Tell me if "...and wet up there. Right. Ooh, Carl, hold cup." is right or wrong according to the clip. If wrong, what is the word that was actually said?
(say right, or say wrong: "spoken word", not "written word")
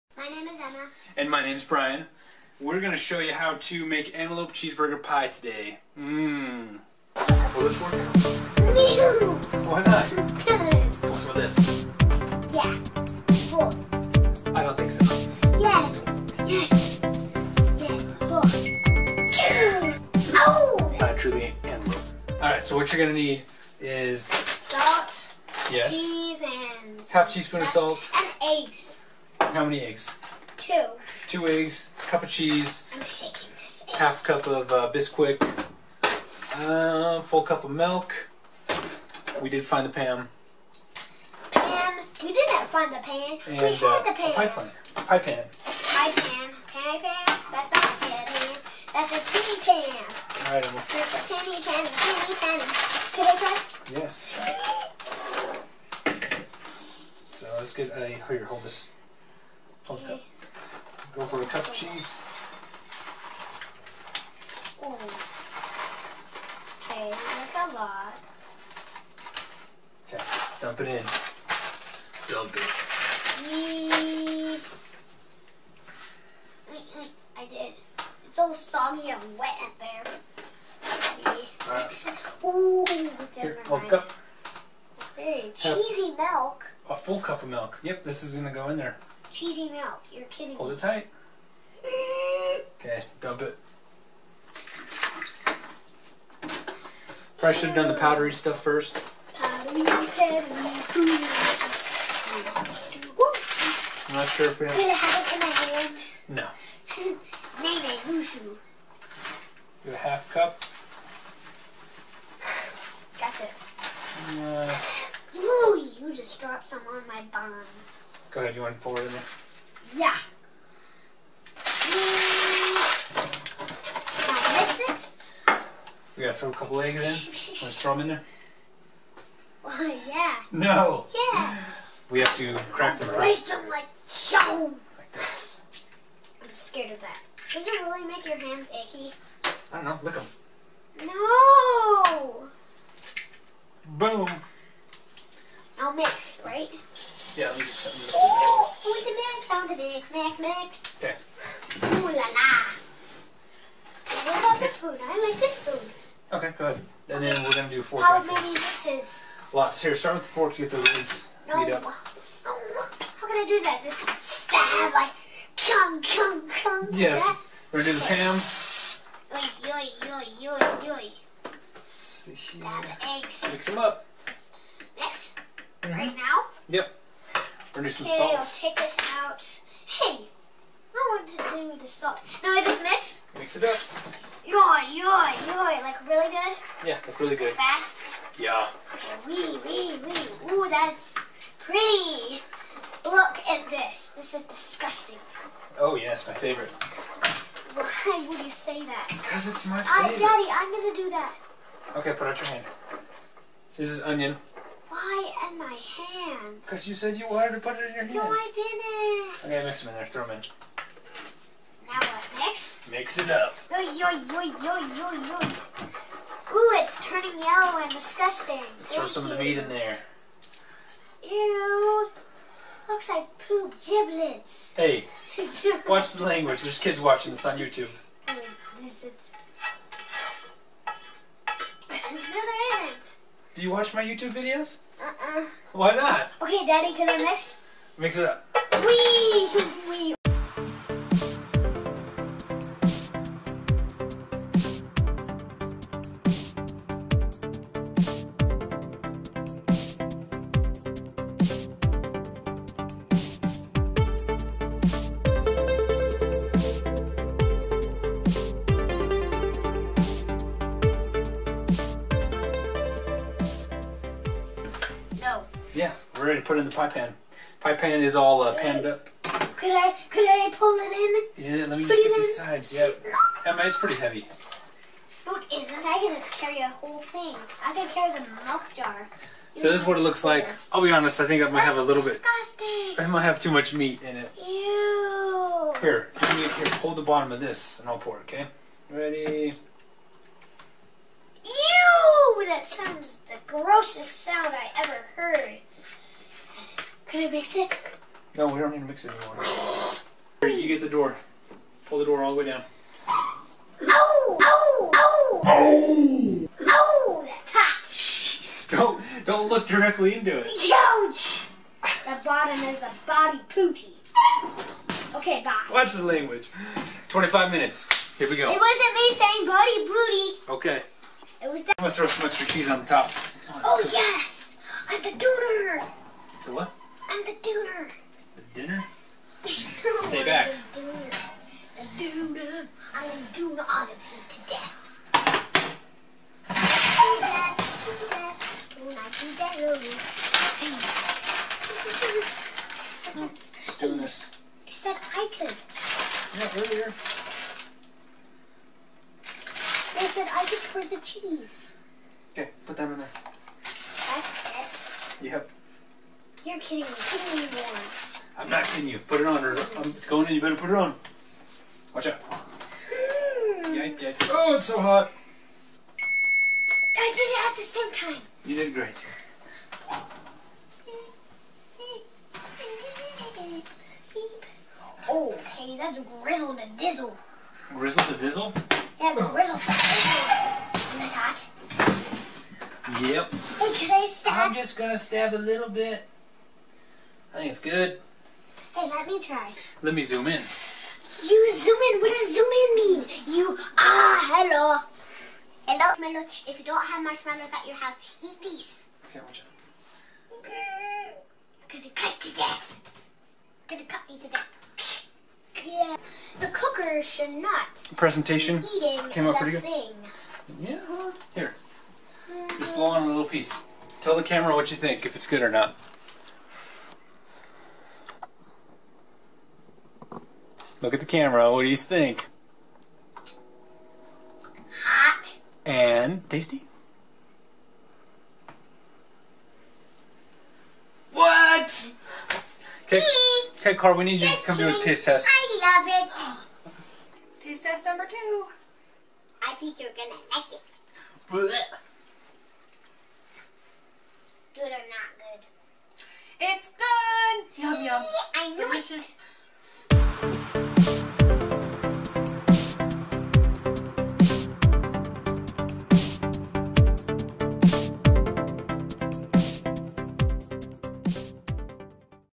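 wrong: "Here", not "Carl".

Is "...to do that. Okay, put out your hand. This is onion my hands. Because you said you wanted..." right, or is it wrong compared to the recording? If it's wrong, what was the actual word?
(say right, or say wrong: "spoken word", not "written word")
right.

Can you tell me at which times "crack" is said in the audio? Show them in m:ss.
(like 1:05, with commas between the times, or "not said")
2:12.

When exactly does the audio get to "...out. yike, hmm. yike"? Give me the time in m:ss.
6:02.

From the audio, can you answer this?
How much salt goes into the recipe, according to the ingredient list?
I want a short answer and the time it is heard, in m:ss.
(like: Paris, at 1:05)
Half teaspoon, at 0:27.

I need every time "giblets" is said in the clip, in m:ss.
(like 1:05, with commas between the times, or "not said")
3:43.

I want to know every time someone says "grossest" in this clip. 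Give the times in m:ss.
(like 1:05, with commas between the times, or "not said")
4:53.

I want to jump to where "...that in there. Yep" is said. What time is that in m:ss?
5:52.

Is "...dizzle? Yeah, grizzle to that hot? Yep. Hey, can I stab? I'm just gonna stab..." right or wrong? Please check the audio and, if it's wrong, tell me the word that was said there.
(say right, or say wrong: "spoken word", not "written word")
right.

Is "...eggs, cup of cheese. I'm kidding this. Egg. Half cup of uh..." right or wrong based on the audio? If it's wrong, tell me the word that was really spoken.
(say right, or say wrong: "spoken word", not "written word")
wrong: "shaking", not "kidding".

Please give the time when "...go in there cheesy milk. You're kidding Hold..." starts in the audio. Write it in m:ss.
1:28.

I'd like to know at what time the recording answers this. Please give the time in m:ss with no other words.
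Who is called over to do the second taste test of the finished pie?
7:13.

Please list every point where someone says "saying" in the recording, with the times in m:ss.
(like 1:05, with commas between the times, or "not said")
5:19.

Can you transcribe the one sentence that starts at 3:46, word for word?
There's kids watching this on YouTube.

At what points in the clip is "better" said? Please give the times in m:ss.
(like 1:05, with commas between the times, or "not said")
6:00.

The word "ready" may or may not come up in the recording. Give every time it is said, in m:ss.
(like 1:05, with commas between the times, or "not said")
4:26, 4:48.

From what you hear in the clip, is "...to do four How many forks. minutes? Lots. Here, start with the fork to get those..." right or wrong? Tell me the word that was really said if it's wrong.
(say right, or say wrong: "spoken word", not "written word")
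wrong: "misses", not "minutes".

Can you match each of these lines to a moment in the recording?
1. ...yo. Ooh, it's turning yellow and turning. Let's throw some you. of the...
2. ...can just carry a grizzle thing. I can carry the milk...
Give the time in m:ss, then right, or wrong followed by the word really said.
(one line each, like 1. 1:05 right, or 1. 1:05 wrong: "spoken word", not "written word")
1. 3:35 wrong: "disgusting", not "turning"
2. 4:35 wrong: "whole", not "grizzle".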